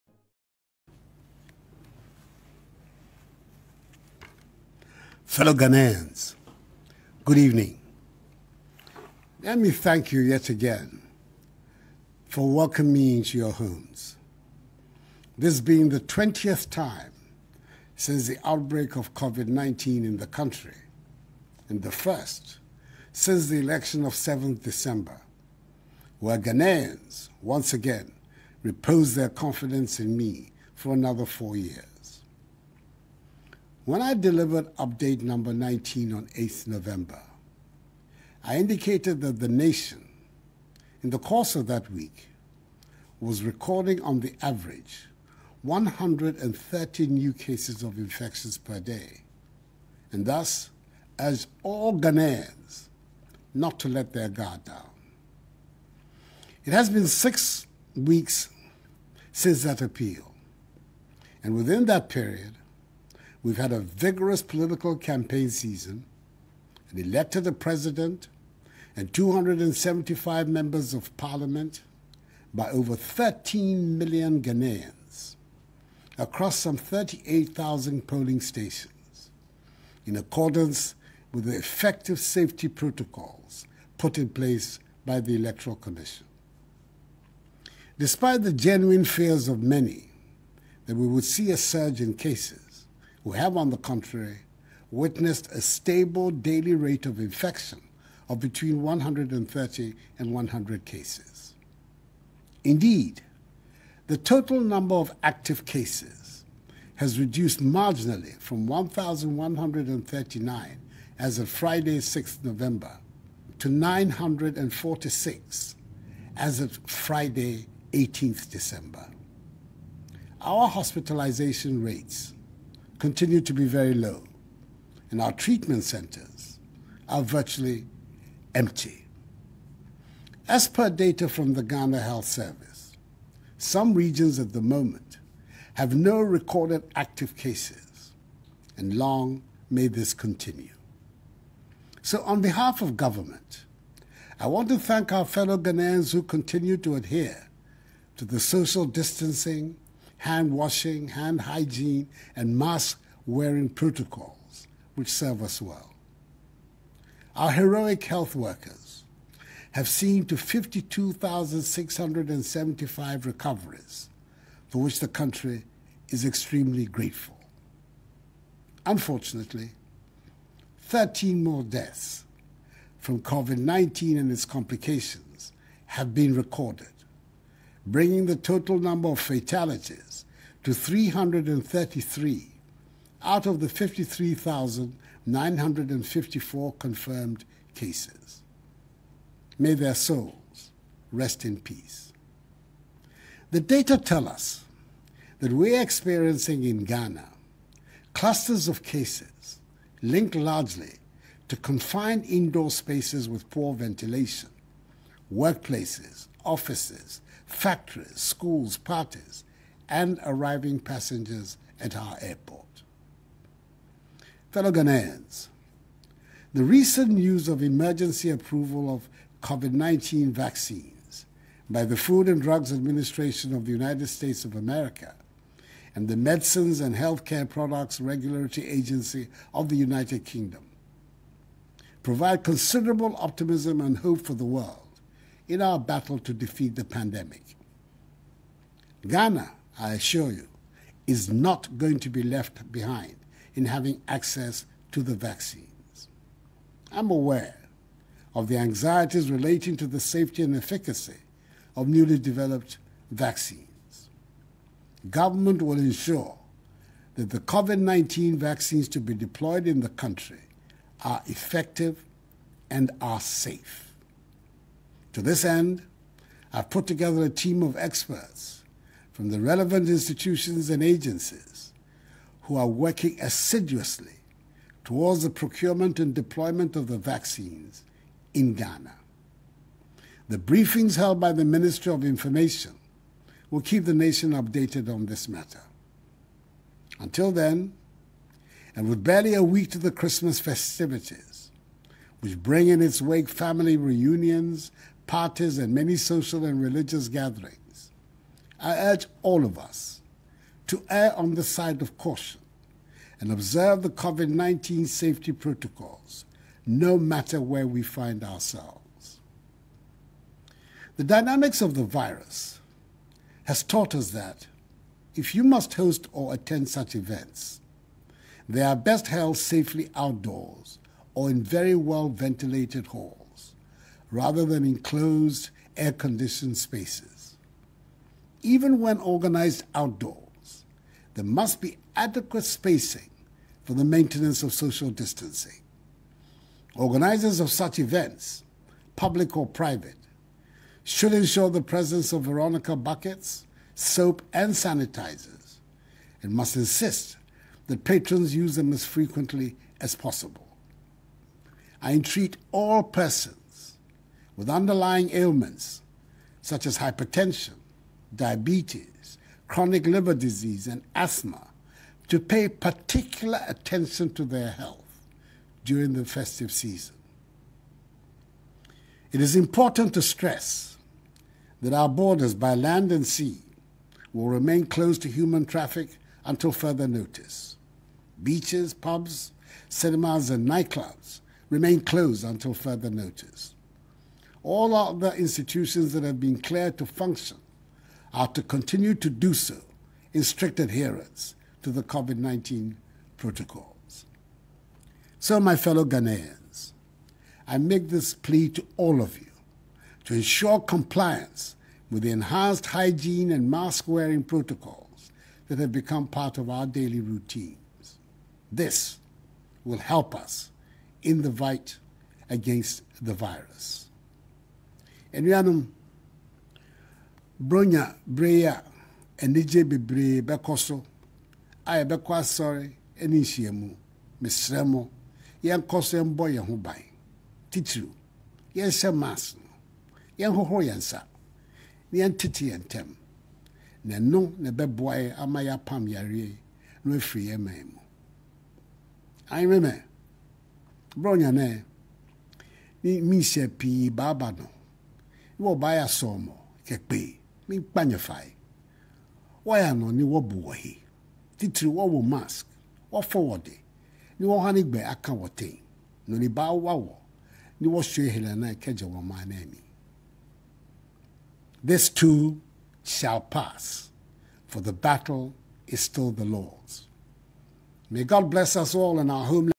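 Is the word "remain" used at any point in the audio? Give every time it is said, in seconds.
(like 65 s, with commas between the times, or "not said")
374 s, 381 s.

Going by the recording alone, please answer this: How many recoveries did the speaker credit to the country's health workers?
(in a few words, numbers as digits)
52,675.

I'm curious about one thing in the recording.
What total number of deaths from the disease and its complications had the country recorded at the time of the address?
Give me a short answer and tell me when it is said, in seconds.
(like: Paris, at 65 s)
333, at 180 s.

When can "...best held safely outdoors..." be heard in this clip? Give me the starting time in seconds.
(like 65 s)
318 s.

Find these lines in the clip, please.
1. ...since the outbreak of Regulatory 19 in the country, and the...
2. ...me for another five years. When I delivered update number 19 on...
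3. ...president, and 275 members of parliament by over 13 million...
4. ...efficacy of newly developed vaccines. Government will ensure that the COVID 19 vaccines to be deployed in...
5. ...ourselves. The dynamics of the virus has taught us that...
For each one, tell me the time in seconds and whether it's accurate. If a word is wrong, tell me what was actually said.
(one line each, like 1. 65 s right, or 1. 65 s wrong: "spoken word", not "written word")
1. 17 s wrong: "COVID", not "Regulatory"
2. 30 s wrong: "four", not "five"
3. 67 s right
4. 250 s right
5. 308 s right.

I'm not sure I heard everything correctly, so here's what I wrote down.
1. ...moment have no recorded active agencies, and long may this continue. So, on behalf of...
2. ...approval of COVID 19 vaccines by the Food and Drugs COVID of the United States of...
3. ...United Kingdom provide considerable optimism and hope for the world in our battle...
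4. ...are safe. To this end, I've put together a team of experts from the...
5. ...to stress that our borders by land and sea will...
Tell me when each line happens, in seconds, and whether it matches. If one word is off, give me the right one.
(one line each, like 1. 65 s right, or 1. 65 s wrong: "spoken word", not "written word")
1. 134 s wrong: "cases", not "agencies"
2. 218 s wrong: "Administration", not "COVID"
3. 229 s right
4. 263 s right
5. 369 s right.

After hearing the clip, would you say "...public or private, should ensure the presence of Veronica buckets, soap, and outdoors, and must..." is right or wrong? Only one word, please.
wrong.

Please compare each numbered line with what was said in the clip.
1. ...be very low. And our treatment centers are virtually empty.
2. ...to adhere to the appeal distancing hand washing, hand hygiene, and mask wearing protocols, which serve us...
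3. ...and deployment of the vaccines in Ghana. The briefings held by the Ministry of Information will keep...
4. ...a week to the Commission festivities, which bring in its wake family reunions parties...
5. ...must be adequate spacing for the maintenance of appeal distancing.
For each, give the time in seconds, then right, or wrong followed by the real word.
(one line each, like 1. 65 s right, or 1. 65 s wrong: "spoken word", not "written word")
1. 123 s right
2. 146 s wrong: "social", not "appeal"
3. 275 s right
4. 289 s wrong: "Christmas", not "Commission"
5. 331 s wrong: "social", not "appeal".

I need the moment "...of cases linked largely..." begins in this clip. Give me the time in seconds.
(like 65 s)
198 s.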